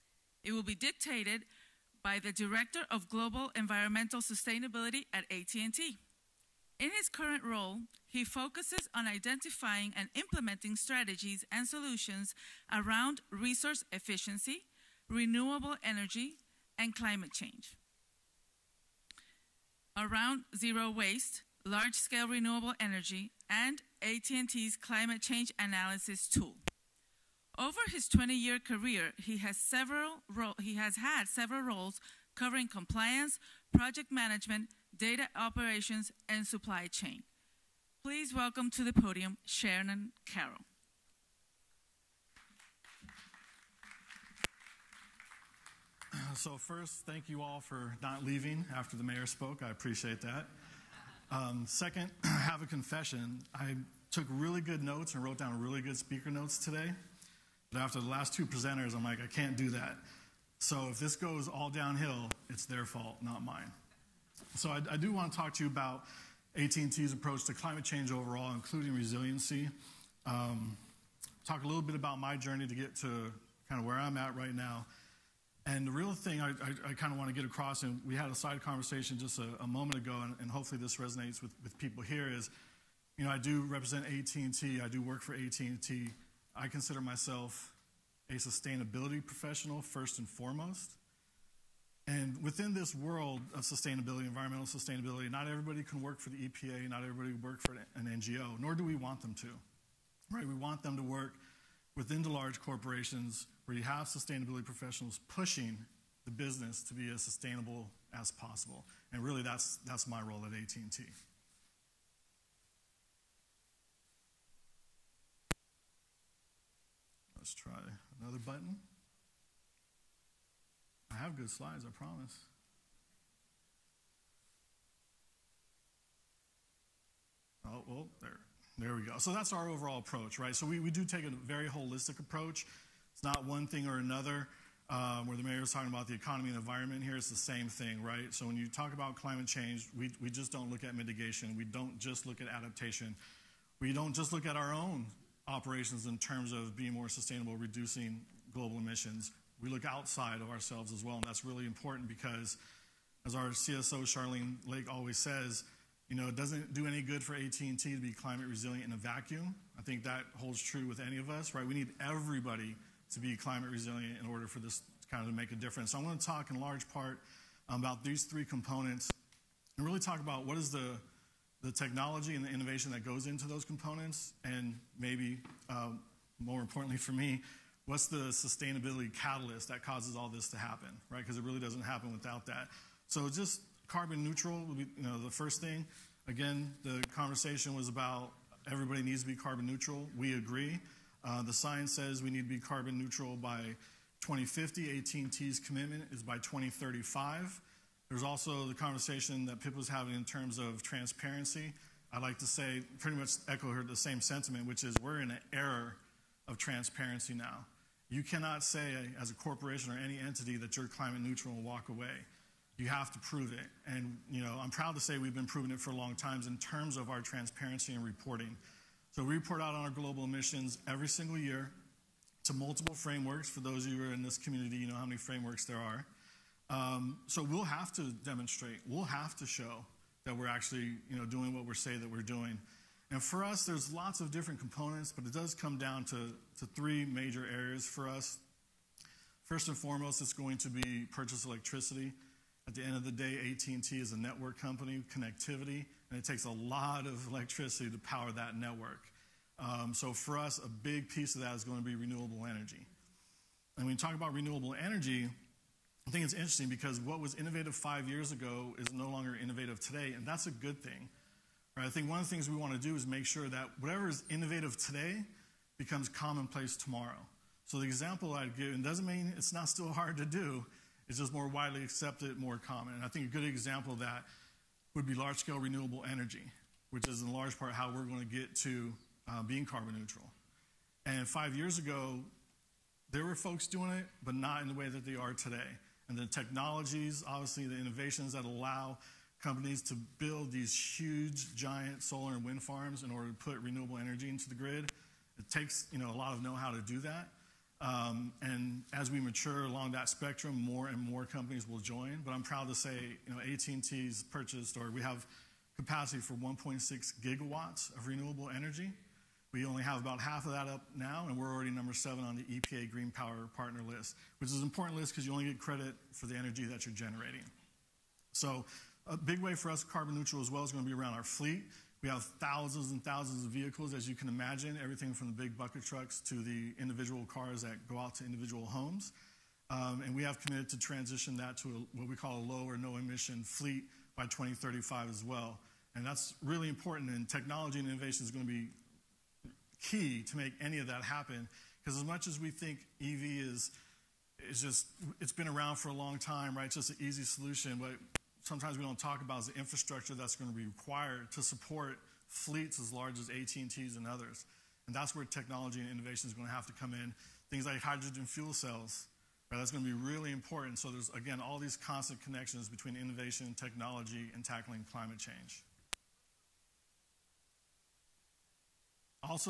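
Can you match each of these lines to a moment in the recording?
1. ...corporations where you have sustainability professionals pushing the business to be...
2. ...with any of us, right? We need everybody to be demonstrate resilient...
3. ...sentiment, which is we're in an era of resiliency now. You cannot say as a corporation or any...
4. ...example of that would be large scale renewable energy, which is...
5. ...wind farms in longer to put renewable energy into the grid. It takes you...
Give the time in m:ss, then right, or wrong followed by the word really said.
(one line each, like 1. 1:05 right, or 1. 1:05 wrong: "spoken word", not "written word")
1. 1:42 right
2. 2:40 wrong: "climate", not "demonstrate"
3. 3:24 wrong: "transparency", not "resiliency"
4. 4:33 right
5. 4:52 wrong: "order", not "longer".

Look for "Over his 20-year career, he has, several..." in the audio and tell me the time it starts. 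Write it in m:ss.
0:27.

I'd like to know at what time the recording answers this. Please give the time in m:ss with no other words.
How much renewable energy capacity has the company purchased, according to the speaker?
5:06.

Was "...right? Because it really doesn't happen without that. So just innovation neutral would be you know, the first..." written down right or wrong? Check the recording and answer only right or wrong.
wrong.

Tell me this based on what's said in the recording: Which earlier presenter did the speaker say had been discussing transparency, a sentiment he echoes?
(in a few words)
Pip.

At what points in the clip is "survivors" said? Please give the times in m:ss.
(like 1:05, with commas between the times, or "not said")
not said.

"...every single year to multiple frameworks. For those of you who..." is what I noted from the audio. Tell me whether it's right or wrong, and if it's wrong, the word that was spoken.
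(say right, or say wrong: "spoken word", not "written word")
right.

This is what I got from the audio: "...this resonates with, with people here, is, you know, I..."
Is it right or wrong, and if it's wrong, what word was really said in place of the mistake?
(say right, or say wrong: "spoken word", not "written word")
right.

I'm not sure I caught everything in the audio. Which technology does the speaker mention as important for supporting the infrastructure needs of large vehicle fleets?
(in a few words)
hydrogen fuel cells.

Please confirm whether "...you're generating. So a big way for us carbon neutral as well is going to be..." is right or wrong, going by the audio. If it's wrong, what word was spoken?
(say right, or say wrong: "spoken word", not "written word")
right.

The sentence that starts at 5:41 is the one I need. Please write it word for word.
Because as much as we think EV is, is just, it's been around for a long time, right?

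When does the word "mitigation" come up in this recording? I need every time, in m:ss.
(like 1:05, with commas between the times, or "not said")
2:20.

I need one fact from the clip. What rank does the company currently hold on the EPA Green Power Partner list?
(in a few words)
number seven.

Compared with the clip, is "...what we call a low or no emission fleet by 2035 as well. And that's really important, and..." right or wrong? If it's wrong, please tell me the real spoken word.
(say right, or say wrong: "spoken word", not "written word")
right.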